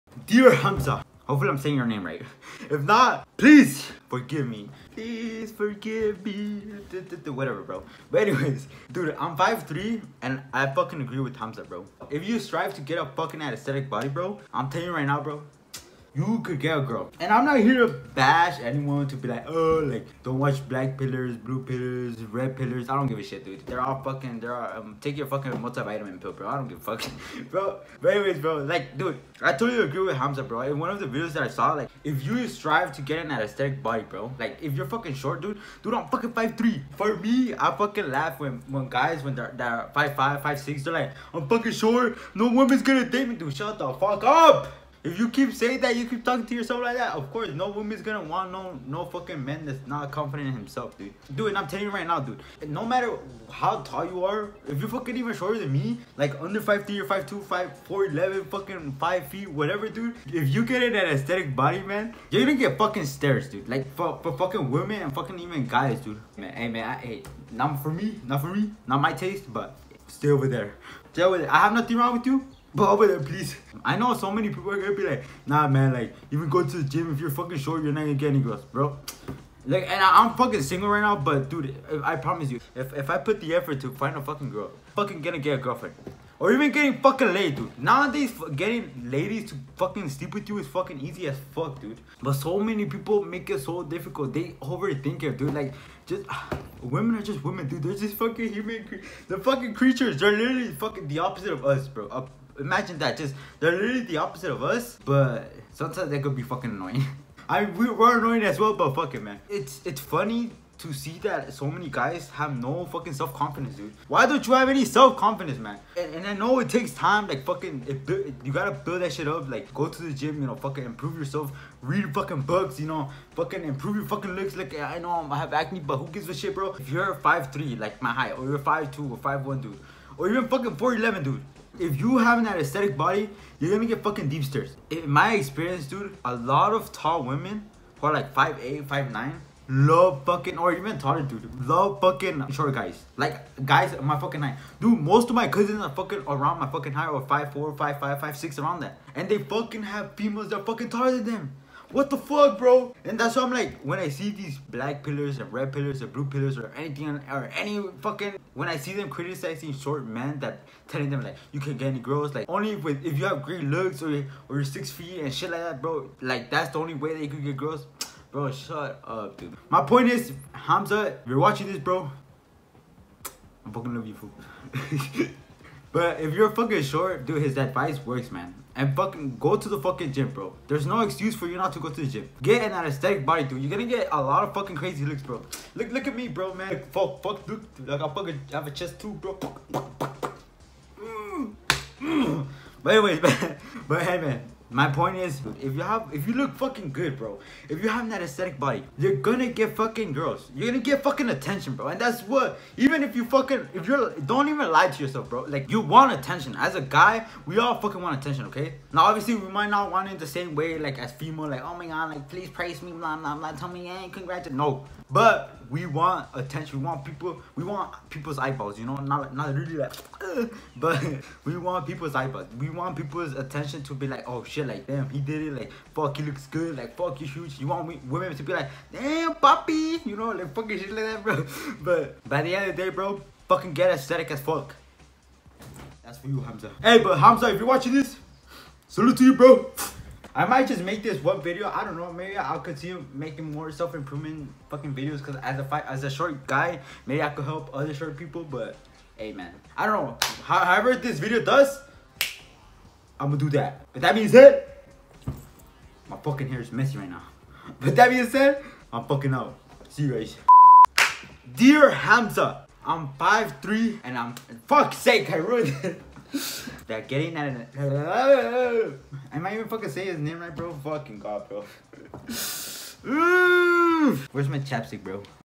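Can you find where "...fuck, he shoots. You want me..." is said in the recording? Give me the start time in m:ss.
3:46.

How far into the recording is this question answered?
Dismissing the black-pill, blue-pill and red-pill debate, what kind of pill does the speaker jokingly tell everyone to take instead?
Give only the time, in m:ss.
0:25.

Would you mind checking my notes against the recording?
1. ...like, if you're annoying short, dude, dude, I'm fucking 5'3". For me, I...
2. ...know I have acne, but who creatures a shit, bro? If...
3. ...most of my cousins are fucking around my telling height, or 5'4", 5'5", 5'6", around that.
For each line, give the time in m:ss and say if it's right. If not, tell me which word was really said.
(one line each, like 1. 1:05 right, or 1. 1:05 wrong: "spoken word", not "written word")
1. 0:34 wrong: "fucking", not "annoying"
2. 2:04 wrong: "gives", not "creatures"
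3. 2:24 wrong: "fucking", not "telling".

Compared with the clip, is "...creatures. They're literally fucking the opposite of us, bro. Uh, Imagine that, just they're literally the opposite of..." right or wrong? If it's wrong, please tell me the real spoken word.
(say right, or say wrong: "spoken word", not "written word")
right.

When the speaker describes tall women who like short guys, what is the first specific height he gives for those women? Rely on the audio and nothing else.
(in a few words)
5'8".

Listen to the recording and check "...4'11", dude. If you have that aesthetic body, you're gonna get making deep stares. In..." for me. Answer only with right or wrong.
wrong.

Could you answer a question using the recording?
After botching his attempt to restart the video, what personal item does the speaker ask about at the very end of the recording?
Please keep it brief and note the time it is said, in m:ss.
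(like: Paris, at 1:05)
chapstick, at 4:34.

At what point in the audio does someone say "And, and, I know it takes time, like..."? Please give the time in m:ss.
1:55.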